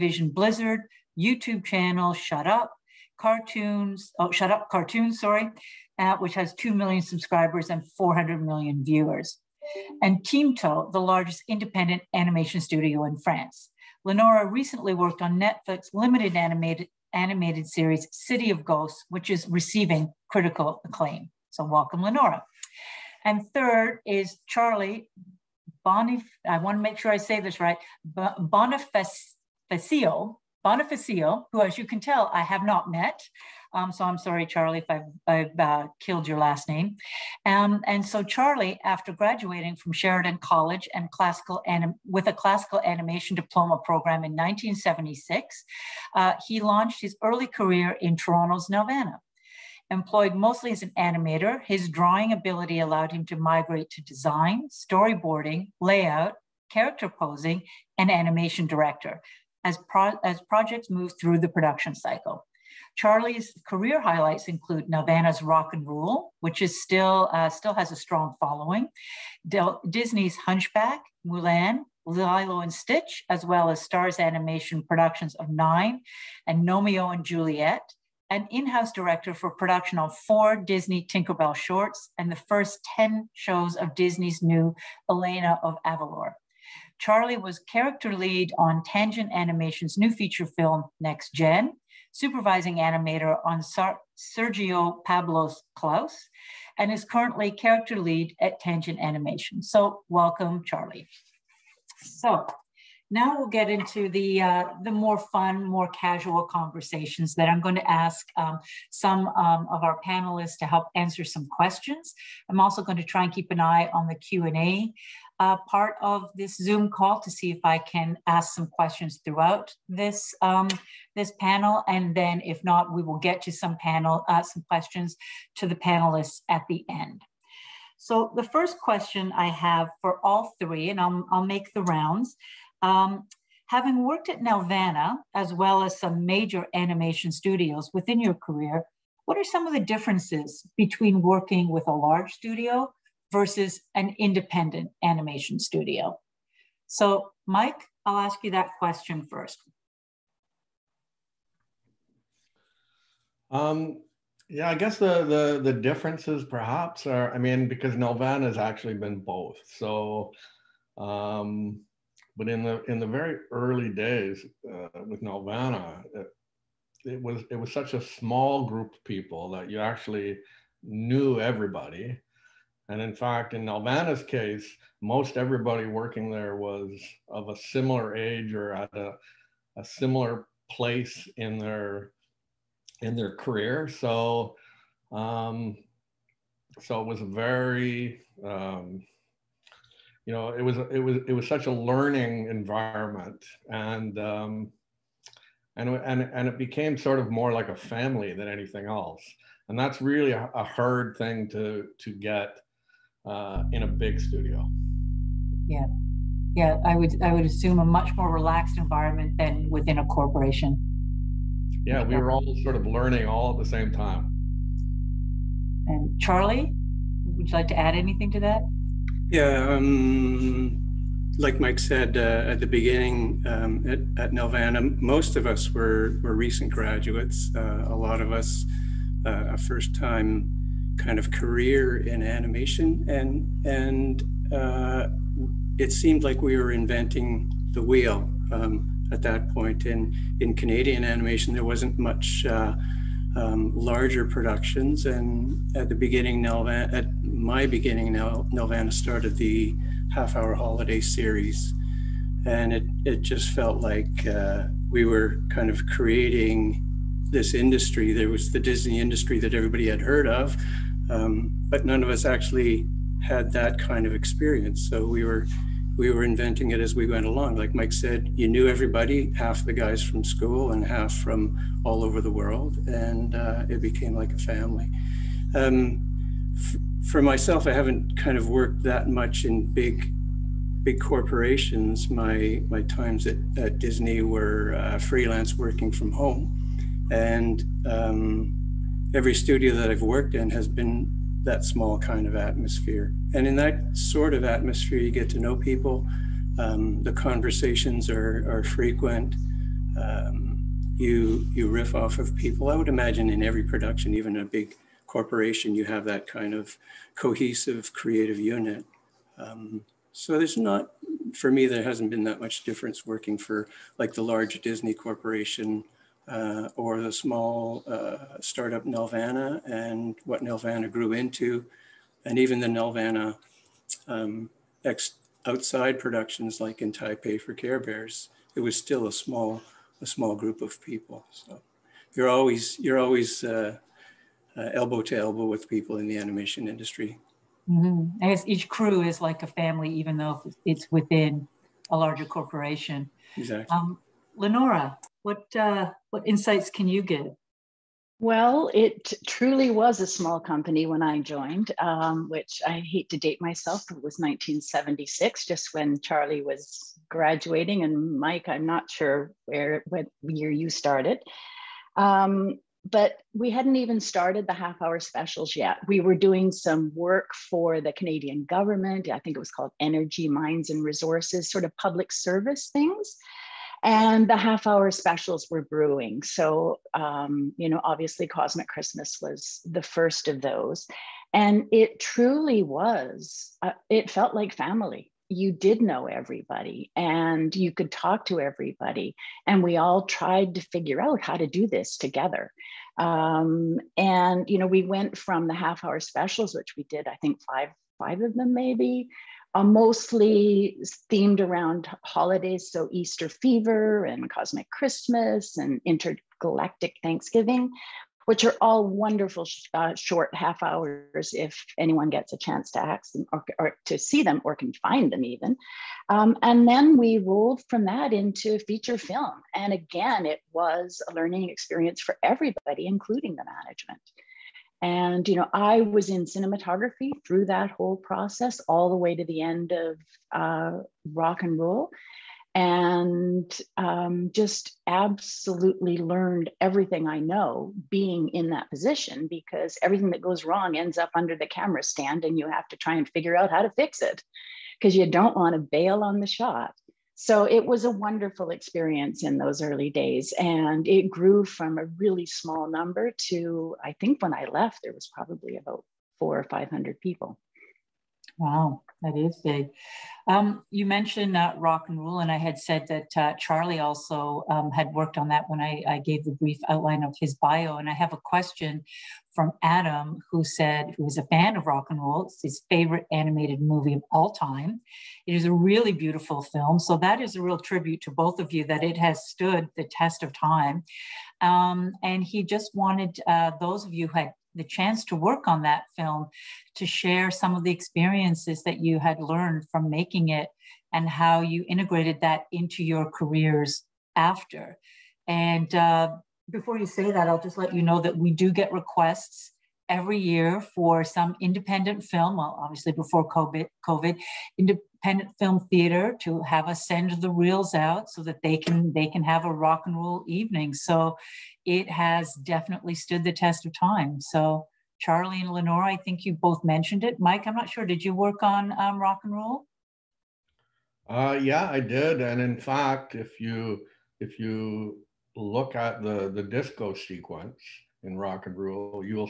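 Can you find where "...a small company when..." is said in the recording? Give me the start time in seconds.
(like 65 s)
349 s.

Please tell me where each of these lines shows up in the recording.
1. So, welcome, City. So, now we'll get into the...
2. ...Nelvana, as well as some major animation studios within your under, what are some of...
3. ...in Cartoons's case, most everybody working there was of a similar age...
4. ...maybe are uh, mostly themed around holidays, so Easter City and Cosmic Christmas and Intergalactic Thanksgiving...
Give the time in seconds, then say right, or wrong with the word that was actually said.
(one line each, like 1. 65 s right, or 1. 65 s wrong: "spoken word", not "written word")
1. 99 s wrong: "Charlie", not "City"
2. 134 s wrong: "career", not "under"
3. 173 s wrong: "Nelvana", not "Cartoons"
4. 398 s wrong: "Fever", not "City".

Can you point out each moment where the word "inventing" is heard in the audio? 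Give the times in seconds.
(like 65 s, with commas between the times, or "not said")
236 s, 266 s.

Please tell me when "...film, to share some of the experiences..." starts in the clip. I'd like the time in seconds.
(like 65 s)
485 s.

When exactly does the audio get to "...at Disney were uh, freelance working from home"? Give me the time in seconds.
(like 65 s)
283 s.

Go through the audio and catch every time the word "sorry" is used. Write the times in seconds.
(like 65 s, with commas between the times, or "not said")
5 s, 34 s.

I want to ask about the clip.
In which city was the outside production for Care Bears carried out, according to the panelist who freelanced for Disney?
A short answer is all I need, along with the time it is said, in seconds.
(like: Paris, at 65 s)
Taipei, at 326 s.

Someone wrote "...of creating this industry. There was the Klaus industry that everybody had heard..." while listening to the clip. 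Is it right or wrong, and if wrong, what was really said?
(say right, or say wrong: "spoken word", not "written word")
wrong: "Disney", not "Klaus".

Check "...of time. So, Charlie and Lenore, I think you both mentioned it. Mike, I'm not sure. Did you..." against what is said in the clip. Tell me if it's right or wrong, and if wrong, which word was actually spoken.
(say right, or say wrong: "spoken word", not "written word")
right.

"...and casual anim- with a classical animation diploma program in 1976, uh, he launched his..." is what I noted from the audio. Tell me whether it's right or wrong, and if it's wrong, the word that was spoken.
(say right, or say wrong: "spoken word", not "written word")
wrong: "classical", not "casual".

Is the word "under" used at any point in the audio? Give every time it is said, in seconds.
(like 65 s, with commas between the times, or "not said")
441 s.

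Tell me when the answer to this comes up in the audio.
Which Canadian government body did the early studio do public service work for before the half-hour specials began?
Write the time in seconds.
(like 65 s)
369 s.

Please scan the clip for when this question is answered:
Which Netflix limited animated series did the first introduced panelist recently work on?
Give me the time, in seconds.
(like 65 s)
18 s.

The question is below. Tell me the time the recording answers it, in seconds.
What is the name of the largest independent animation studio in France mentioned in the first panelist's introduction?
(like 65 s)
10 s.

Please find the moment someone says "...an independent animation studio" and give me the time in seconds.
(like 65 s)
143 s.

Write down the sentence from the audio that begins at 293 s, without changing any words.
And in that sort of atmosphere, you get to know people.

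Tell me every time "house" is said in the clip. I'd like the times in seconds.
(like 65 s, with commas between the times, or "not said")
78 s.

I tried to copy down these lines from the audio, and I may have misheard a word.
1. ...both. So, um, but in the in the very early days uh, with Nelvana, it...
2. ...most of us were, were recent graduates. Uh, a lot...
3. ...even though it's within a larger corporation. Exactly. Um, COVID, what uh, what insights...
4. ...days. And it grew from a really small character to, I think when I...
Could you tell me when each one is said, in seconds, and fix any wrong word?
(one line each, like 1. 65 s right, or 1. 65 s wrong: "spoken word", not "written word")
1. 159 s right
2. 225 s right
3. 339 s wrong: "Lenora", not "COVID"
4. 449 s wrong: "number", not "character".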